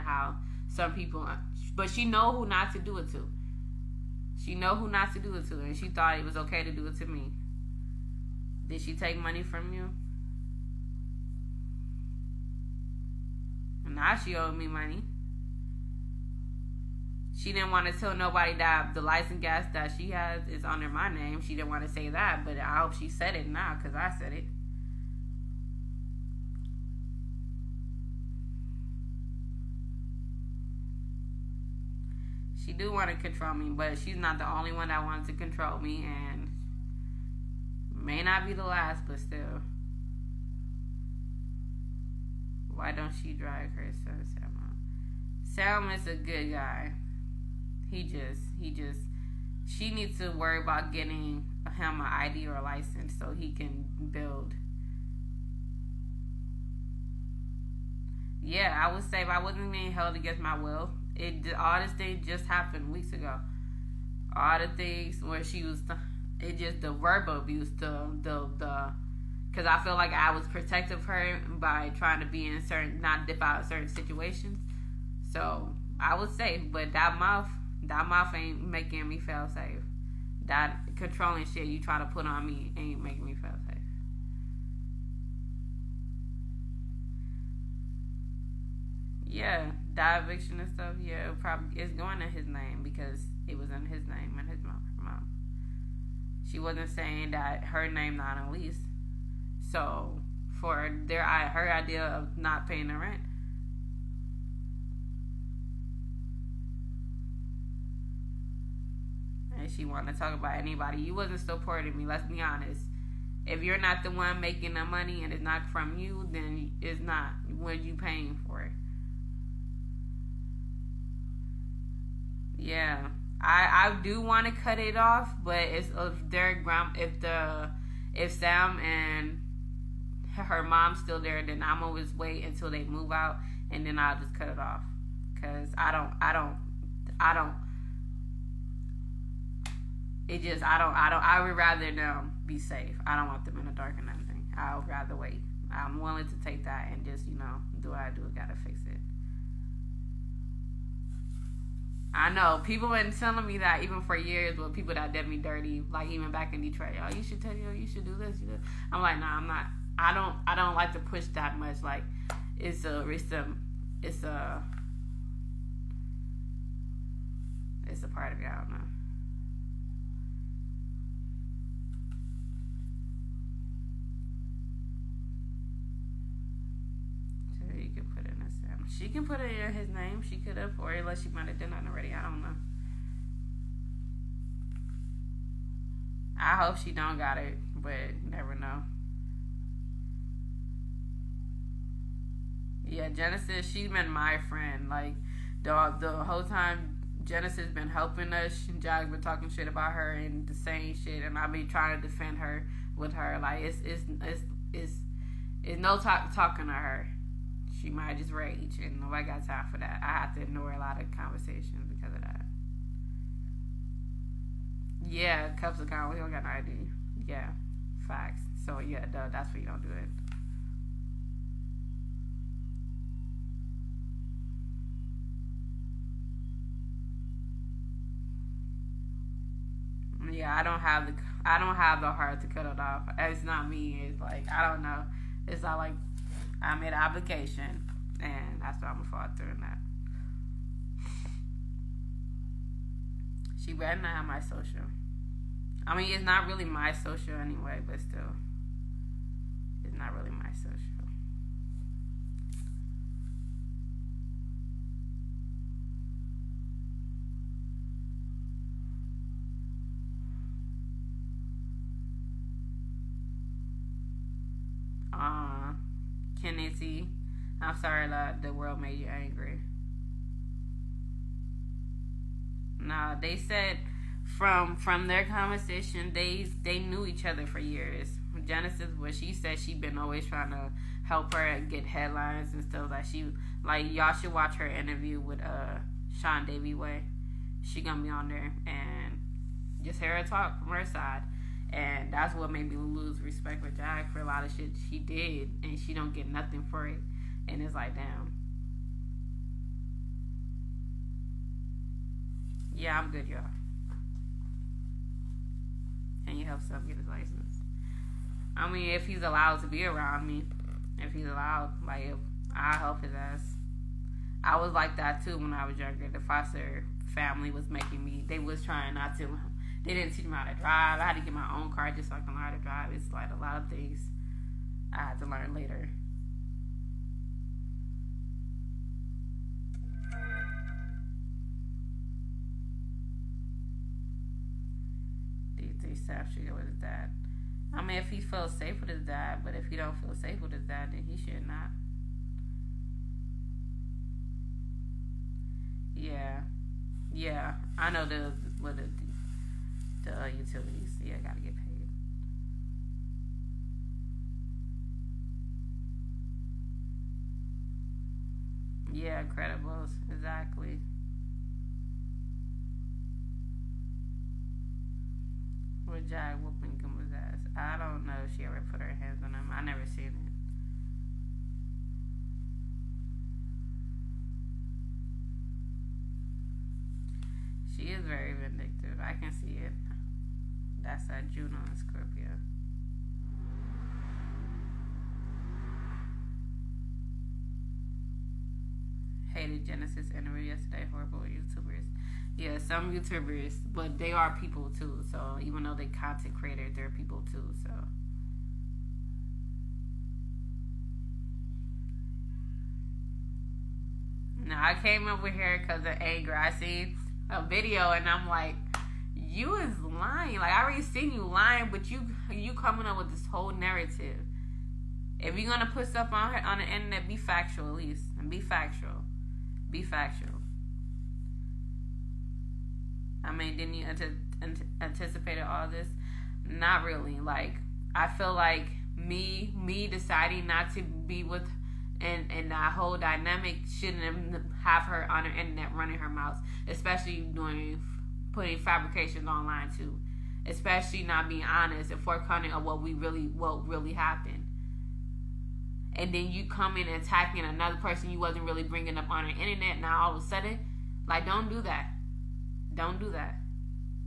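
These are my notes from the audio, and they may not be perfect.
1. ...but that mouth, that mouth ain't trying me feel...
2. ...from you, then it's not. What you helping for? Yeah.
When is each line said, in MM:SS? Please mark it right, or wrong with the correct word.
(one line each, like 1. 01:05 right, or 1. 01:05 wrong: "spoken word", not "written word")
1. 01:16 wrong: "making", not "trying"
2. 01:55 wrong: "paying", not "helping".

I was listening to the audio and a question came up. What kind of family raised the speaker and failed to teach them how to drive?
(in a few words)
foster family.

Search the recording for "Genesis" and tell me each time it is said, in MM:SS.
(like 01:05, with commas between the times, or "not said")
03:13, 03:17, 04:38, 06:29.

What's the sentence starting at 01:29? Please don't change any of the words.
yeah, die eviction and stuff, yeah, it probably it's going in his name because it was in his name and his mom.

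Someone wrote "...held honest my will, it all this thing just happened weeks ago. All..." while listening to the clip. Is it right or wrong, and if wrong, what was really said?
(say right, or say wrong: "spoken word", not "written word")
wrong: "against", not "honest".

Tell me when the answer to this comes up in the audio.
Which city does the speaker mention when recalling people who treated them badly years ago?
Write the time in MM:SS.
02:36.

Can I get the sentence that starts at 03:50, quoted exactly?
Yeah, I don't have the I don't have the heart to cut it off.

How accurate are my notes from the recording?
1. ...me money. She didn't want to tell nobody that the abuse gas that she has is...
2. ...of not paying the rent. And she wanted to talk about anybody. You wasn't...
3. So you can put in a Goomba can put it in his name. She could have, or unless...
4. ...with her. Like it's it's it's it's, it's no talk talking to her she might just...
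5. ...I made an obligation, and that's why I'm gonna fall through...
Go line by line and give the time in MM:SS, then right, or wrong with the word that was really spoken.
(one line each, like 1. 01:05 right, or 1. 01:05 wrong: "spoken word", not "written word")
1. 00:14 wrong: "license", not "abuse"
2. 01:42 right
3. 02:57 wrong: "She", not "Goomba"
4. 03:22 right
5. 03:56 right.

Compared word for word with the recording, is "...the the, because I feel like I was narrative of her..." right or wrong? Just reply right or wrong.
wrong.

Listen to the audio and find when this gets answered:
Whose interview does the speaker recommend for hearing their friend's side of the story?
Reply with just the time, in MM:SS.
04:46.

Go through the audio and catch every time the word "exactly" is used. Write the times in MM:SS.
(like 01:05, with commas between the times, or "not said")
06:00.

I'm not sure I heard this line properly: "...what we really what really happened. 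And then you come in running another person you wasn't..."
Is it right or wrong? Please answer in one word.
wrong.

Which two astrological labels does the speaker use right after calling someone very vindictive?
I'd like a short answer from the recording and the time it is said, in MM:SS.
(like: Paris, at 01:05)
Juno and Scorpio, at 06:21.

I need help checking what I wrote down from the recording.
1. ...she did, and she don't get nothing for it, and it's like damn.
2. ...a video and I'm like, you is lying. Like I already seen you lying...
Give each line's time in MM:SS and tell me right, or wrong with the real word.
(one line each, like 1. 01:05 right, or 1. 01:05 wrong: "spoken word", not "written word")
1. 04:54 right
2. 06:47 right.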